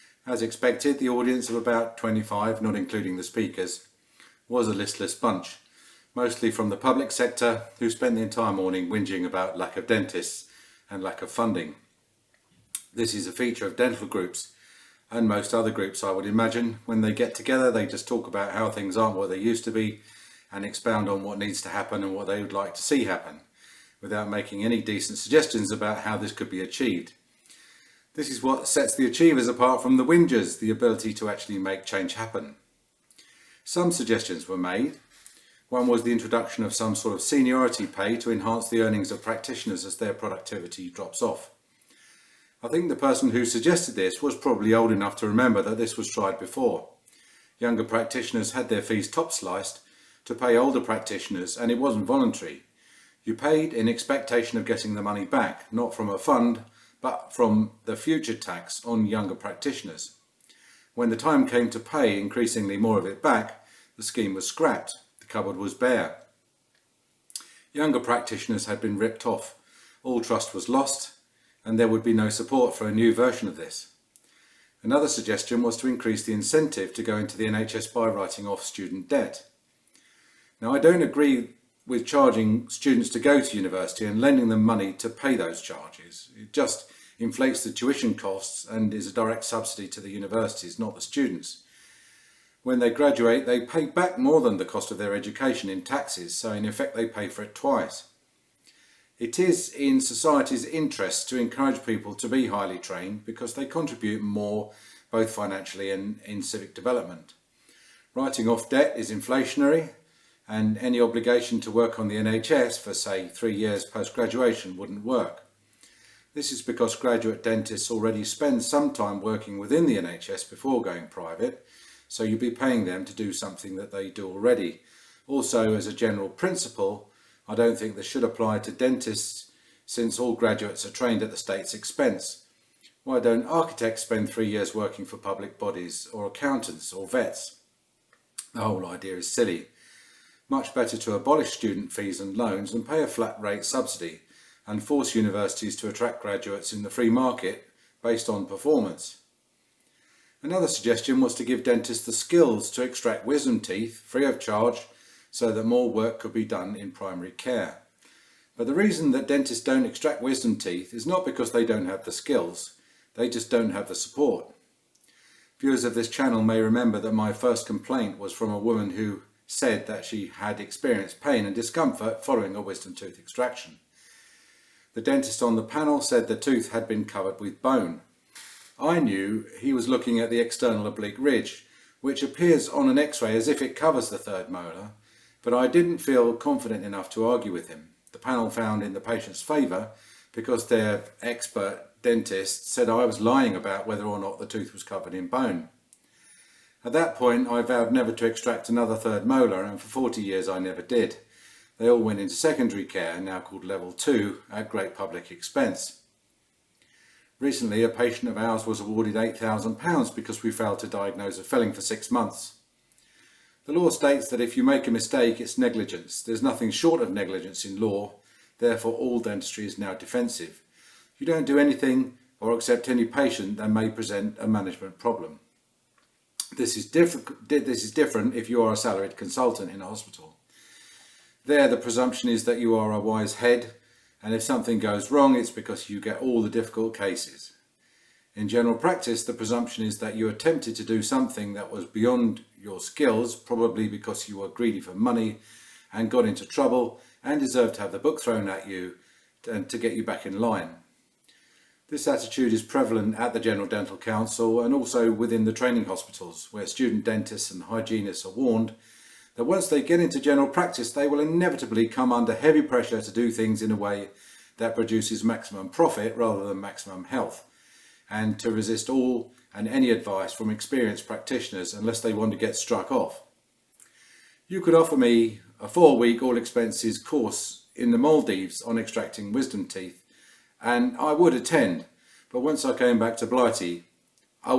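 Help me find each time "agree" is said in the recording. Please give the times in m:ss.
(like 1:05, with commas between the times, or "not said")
1:21.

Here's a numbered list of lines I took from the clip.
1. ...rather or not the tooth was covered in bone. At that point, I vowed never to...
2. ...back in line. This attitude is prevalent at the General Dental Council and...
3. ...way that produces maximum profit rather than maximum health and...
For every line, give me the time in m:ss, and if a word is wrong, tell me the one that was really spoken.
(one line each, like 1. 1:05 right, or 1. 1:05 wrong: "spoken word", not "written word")
1. 3:13 wrong: "whether", not "rather"
2. 4:10 right
3. 4:23 right.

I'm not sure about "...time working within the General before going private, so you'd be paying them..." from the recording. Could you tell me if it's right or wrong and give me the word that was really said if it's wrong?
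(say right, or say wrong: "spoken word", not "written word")
wrong: "NHS", not "General".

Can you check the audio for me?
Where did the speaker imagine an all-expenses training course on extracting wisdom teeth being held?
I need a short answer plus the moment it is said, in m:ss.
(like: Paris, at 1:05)
the Maldives, at 4:37.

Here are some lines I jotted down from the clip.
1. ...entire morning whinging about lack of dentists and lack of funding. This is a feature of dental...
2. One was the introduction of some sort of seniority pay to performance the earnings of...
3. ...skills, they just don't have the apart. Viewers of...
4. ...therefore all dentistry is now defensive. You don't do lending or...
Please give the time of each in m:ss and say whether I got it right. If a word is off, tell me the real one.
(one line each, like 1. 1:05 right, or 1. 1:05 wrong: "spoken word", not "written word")
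1. 0:08 right
2. 0:35 wrong: "enhance", not "performance"
3. 2:42 wrong: "support", not "apart"
4. 3:38 wrong: "anything", not "lending".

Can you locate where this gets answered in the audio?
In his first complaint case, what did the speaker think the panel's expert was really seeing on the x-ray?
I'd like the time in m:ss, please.
3:00.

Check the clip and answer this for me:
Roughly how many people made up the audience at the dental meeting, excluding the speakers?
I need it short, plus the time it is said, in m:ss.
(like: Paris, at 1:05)
25, at 0:01.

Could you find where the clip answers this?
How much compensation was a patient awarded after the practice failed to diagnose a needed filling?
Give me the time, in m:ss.
3:29.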